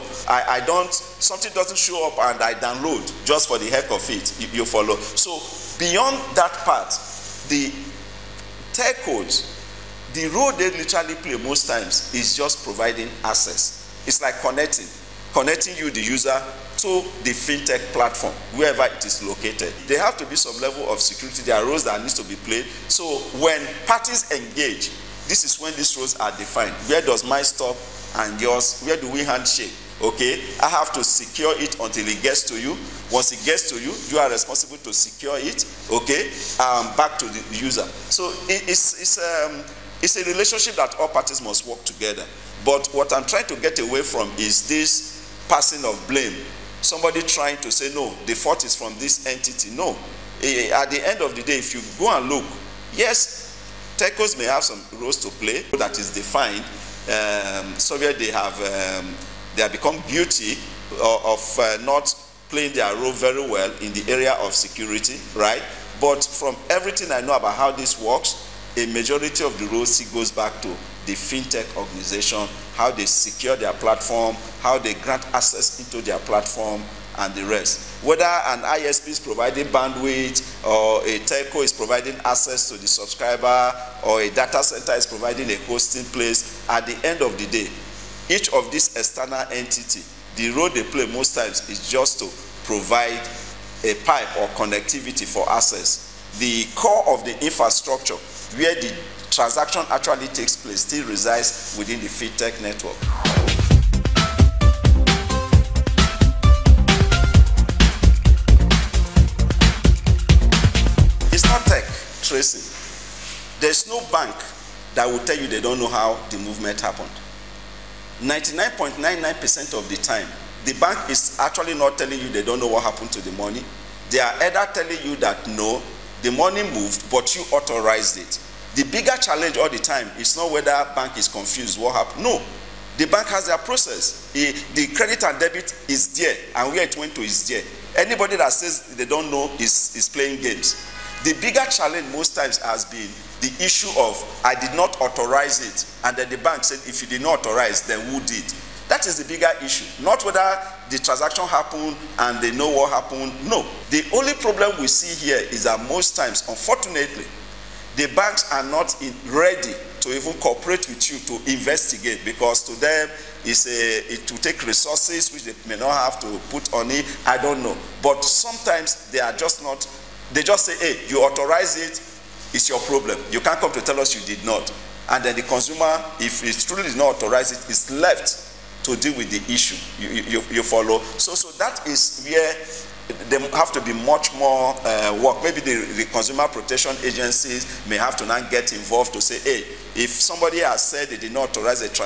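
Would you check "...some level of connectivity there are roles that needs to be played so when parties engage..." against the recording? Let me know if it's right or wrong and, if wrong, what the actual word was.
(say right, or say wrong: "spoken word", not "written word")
wrong: "security", not "connectivity".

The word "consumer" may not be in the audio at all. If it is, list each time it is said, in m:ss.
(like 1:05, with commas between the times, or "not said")
2:55, 3:06.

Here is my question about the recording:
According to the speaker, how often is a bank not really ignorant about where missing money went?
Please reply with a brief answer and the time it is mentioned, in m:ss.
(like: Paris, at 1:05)
99.99%, at 1:58.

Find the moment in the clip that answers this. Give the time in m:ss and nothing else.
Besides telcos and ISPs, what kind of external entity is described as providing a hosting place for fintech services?
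1:24.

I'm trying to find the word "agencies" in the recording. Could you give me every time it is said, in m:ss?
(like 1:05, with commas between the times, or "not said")
3:07.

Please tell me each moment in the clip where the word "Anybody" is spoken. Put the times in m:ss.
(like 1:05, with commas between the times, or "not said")
2:17.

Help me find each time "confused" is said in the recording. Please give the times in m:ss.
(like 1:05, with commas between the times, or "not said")
2:11.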